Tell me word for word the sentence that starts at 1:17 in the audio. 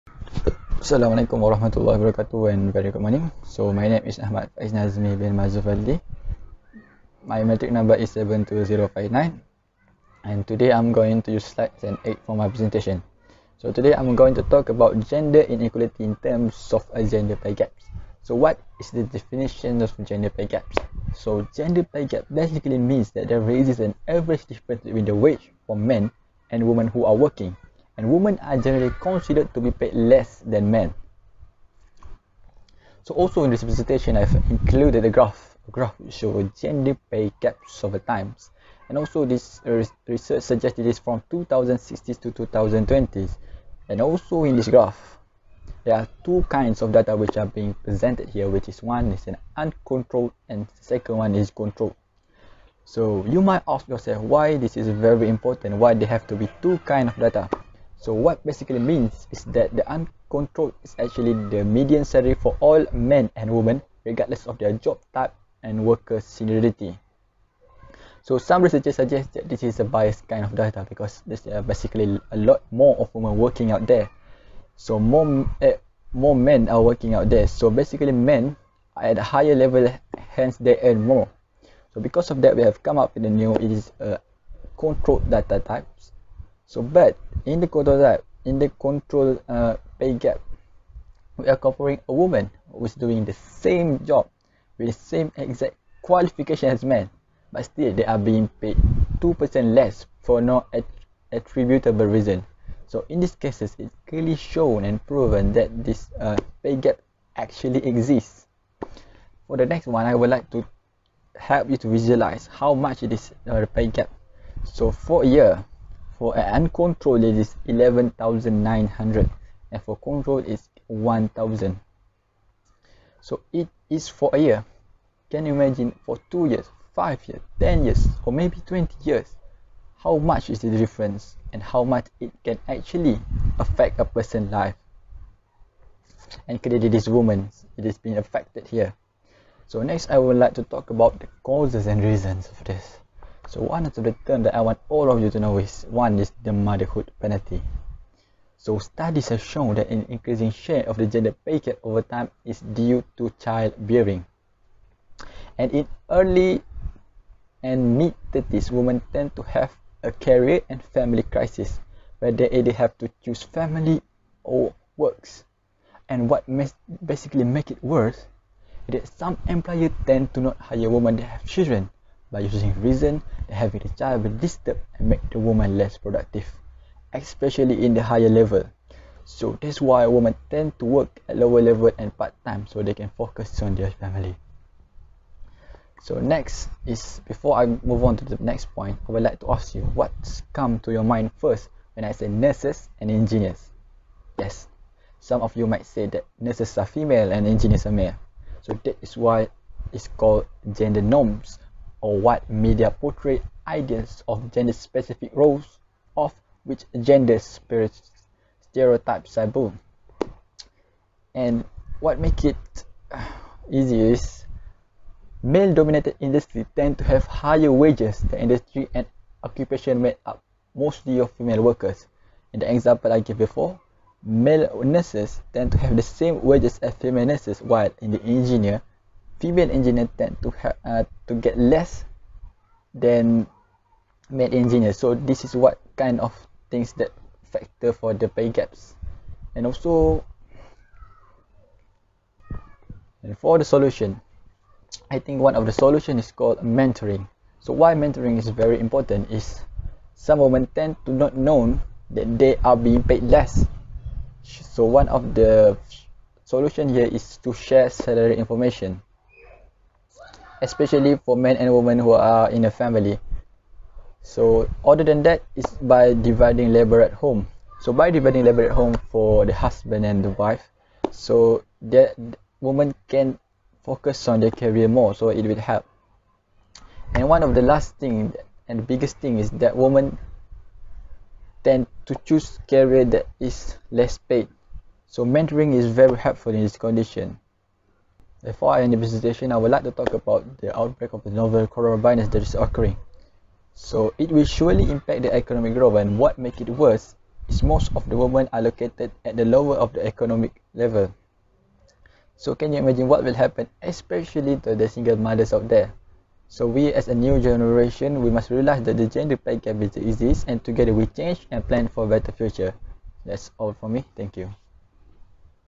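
So basically men are at a higher level, hence they earn more.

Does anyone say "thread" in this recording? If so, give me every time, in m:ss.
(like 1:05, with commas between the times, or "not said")
not said.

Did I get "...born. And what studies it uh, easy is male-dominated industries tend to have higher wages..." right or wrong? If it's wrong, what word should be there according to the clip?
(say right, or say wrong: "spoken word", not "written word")
wrong: "makes", not "studies".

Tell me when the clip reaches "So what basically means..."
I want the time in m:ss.
0:58.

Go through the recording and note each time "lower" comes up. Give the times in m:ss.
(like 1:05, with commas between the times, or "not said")
3:01, 4:59.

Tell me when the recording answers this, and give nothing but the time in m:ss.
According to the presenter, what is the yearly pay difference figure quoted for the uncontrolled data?
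1:57.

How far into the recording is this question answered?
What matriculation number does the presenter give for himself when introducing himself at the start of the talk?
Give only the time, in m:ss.
0:08.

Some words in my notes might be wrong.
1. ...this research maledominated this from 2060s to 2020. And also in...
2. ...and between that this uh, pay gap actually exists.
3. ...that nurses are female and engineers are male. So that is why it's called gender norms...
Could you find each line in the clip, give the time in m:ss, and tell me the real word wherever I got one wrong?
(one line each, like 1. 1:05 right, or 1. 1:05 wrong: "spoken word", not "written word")
1. 0:39 wrong: "suggested", not "maledominated"
2. 1:44 wrong: "proven", not "between"
3. 3:16 right.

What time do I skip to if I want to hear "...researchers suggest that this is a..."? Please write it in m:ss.
1:08.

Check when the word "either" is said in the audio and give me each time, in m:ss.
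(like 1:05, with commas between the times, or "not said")
2:42.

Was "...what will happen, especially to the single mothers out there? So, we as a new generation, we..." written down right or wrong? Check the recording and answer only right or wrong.
right.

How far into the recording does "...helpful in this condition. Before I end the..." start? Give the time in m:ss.
4:46.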